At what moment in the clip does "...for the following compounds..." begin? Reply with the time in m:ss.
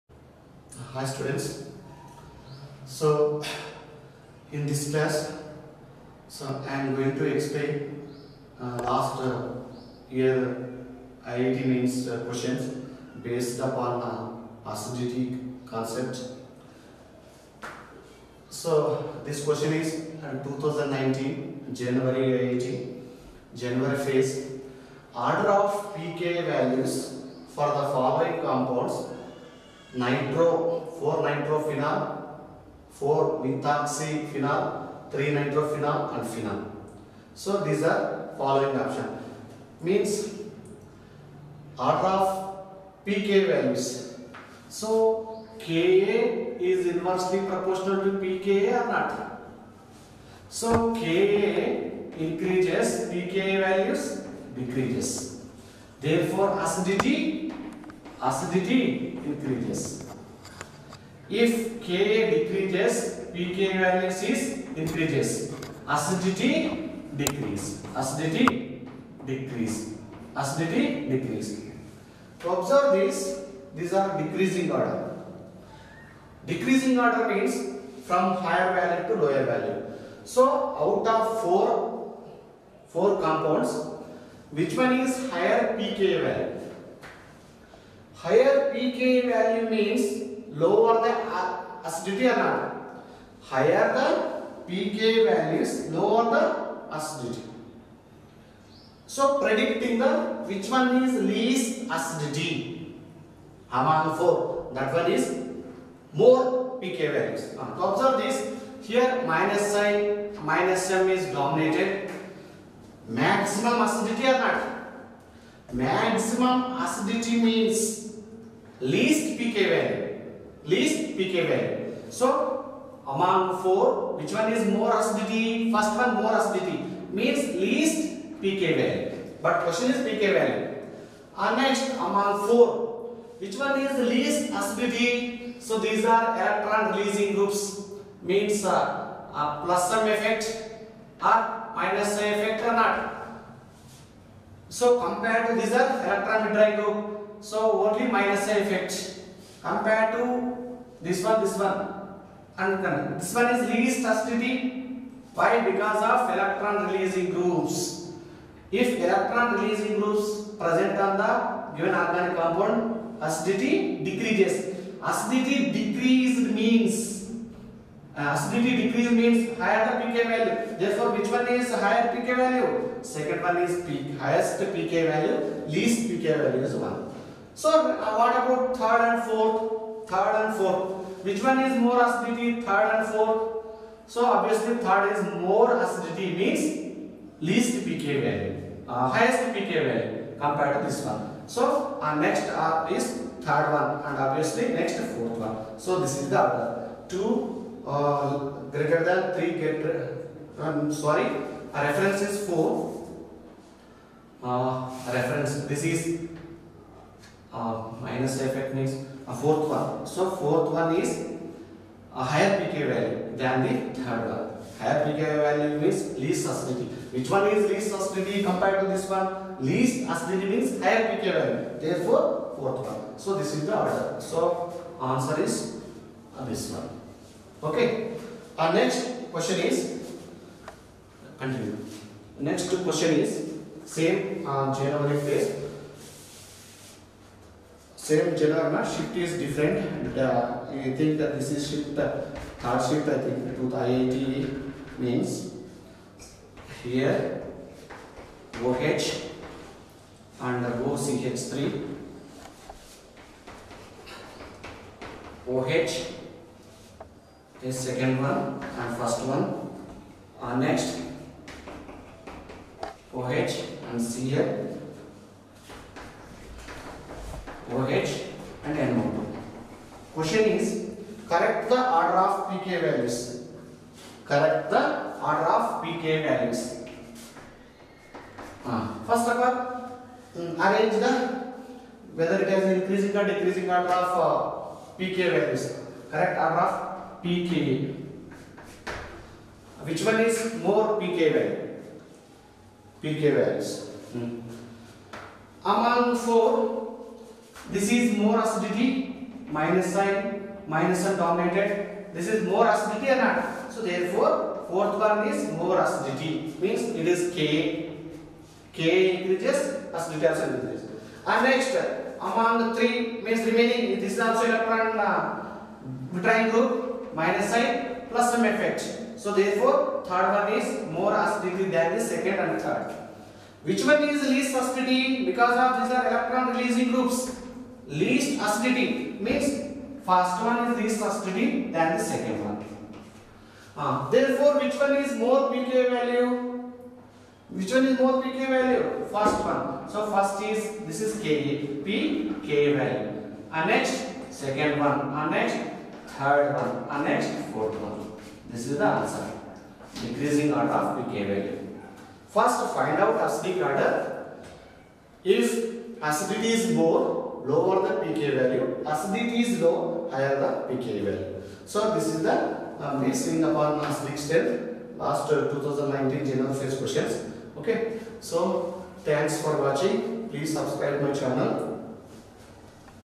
0:27.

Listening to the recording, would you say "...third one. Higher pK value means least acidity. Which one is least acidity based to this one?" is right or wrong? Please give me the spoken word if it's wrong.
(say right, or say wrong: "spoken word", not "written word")
wrong: "compared", not "based".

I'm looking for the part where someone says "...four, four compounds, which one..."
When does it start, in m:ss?
1:21.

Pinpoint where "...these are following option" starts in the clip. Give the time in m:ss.
0:37.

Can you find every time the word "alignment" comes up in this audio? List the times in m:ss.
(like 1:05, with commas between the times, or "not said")
not said.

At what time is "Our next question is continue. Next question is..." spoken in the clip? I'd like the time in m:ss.
3:48.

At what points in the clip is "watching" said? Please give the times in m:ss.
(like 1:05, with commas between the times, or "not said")
6:09.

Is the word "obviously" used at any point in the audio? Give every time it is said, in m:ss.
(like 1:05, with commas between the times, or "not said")
3:04, 3:14.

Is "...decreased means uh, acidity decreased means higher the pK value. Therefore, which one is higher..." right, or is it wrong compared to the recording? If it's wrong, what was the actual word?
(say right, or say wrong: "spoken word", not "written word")
right.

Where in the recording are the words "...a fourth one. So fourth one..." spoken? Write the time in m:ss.
3:29.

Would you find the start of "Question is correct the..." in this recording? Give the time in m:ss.
4:30.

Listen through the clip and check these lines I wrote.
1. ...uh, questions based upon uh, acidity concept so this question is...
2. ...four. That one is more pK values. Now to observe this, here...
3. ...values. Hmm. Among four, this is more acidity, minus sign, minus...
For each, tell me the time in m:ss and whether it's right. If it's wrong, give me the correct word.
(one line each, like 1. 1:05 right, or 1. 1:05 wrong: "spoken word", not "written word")
1. 0:12 right
2. 1:44 right
3. 4:53 right.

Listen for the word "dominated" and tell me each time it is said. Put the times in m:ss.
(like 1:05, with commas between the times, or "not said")
1:51, 5:01.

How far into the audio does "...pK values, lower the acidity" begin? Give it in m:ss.
1:34.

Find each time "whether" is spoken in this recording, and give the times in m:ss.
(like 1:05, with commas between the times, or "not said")
4:42.